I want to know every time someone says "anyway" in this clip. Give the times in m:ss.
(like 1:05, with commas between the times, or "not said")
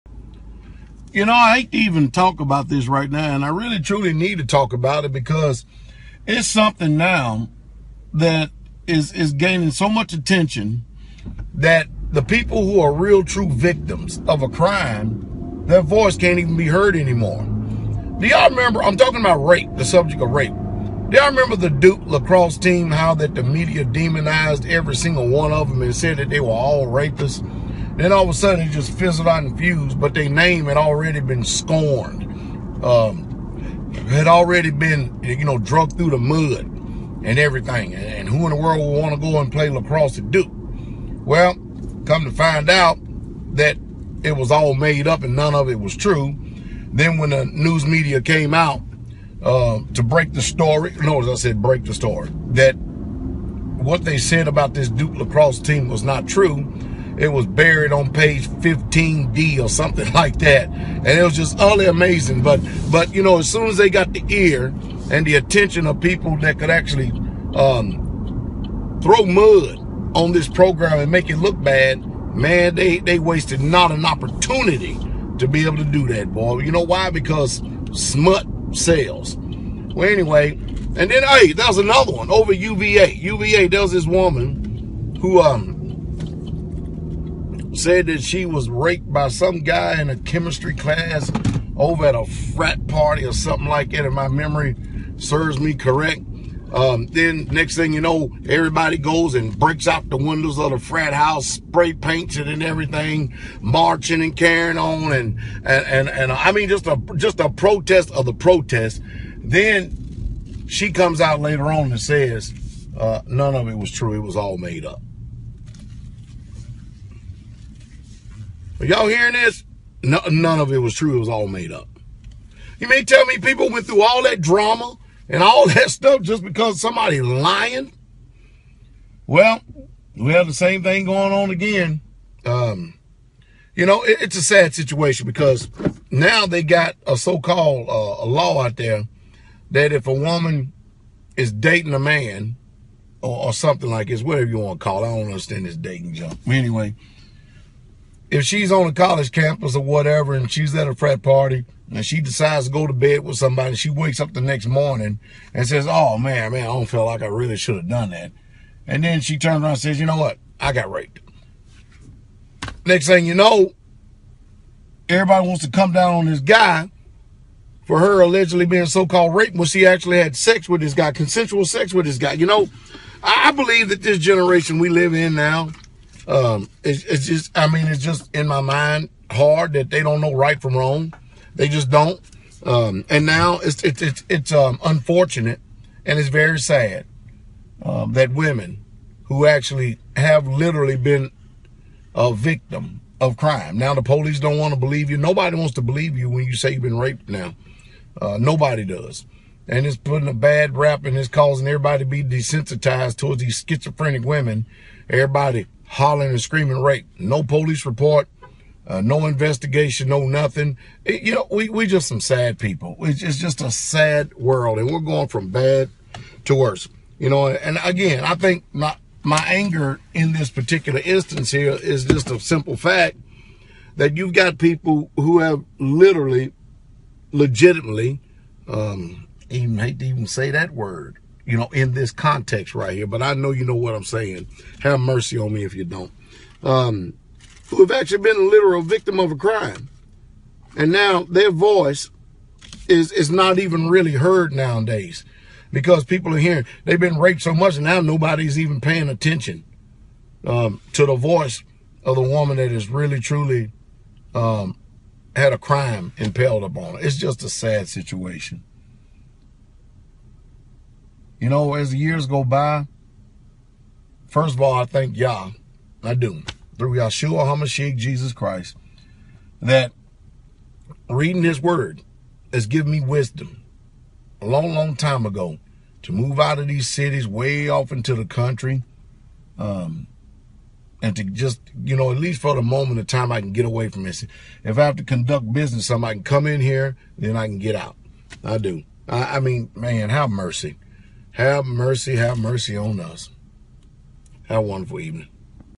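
1:20, 2:26.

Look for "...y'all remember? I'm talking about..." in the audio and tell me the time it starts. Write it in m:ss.
0:18.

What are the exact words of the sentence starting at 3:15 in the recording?
Nobody wants to believe you when you say you've been raped.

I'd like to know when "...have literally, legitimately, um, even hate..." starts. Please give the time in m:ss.
3:45.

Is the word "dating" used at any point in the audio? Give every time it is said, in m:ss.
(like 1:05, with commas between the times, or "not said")
2:21, 2:25.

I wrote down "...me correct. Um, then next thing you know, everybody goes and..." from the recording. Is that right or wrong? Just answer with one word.
right.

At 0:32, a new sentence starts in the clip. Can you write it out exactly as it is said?
Um, had already been, you know, drug through the mud and everything.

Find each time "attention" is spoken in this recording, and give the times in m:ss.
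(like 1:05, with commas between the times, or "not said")
0:10, 1:05, 4:09.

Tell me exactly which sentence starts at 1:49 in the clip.
Then she comes out later on and says, uh, none of it was true.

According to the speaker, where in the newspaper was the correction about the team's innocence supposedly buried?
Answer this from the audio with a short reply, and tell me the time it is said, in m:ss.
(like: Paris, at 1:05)
page 15D, at 0:58.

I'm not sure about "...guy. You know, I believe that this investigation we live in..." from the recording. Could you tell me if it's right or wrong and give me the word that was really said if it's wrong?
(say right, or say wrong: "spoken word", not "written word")
wrong: "generation", not "investigation".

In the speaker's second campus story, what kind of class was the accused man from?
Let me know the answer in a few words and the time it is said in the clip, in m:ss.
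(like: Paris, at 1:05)
chemistry class, at 1:30.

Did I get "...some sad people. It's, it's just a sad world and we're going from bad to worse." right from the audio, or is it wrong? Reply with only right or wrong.
right.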